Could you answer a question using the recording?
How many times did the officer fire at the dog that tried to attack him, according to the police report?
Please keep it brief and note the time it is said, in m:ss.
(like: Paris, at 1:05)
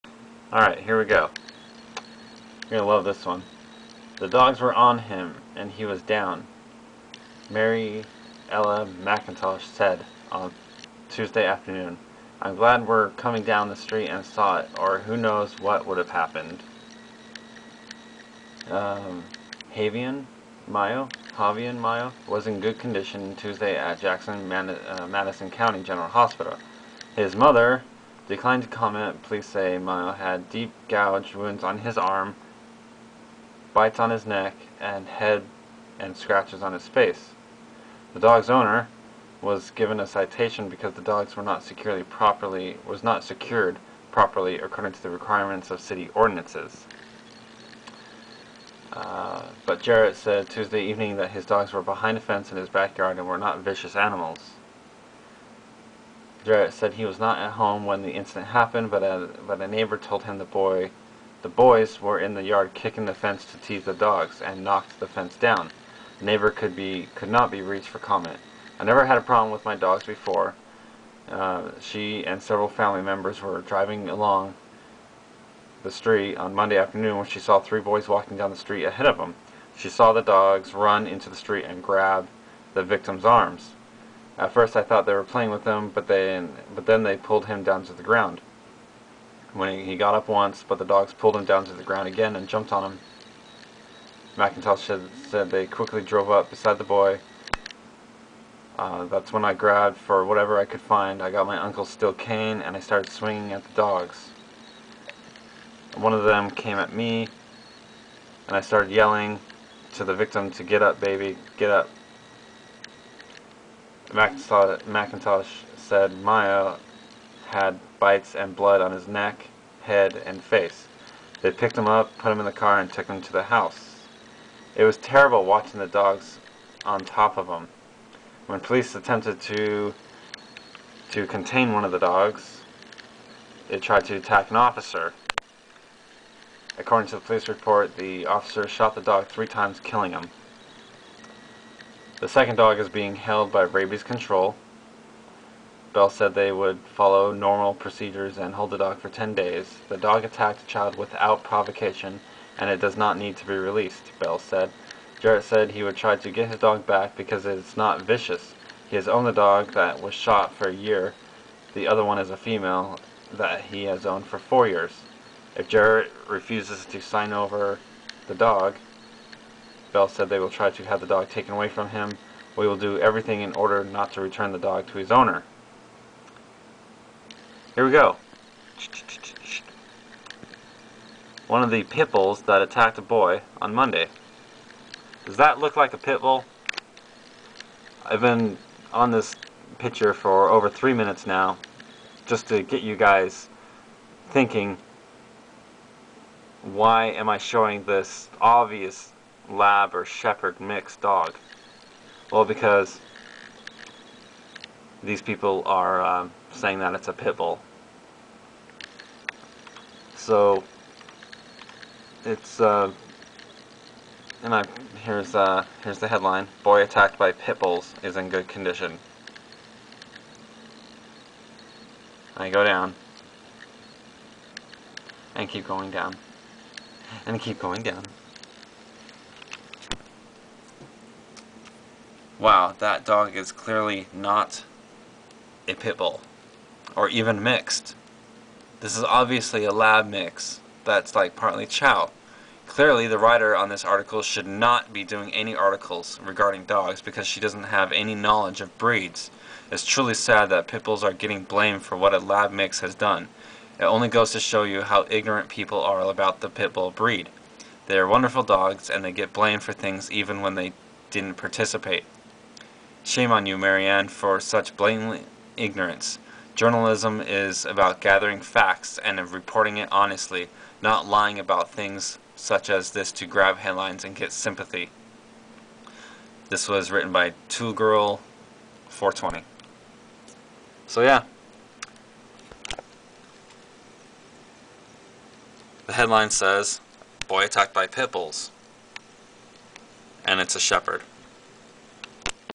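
3, at 2:19.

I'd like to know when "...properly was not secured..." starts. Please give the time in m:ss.
0:42.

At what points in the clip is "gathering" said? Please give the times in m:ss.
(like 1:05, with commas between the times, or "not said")
4:27.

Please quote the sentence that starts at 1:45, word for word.
One of them came at me and I started yelling to the victim to get up, baby, get up.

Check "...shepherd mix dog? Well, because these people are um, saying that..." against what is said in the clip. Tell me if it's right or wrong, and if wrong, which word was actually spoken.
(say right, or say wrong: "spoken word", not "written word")
right.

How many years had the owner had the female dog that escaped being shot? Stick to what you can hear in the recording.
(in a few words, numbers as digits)
4.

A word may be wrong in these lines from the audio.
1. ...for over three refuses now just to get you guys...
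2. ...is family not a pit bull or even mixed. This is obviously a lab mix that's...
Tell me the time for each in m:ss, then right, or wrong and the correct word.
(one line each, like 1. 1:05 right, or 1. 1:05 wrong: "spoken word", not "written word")
1. 3:10 wrong: "minutes", not "refuses"
2. 3:53 wrong: "clearly", not "family".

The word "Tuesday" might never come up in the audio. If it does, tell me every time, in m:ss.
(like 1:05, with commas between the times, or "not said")
0:11, 0:23, 0:50.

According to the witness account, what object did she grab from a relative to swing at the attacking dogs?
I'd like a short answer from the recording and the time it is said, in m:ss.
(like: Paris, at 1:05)
Uncle's steel cane, at 1:41.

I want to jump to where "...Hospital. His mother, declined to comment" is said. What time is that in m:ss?
0:26.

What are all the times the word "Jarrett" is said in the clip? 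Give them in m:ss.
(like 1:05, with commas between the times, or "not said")
0:49, 0:56, 2:35, 2:45.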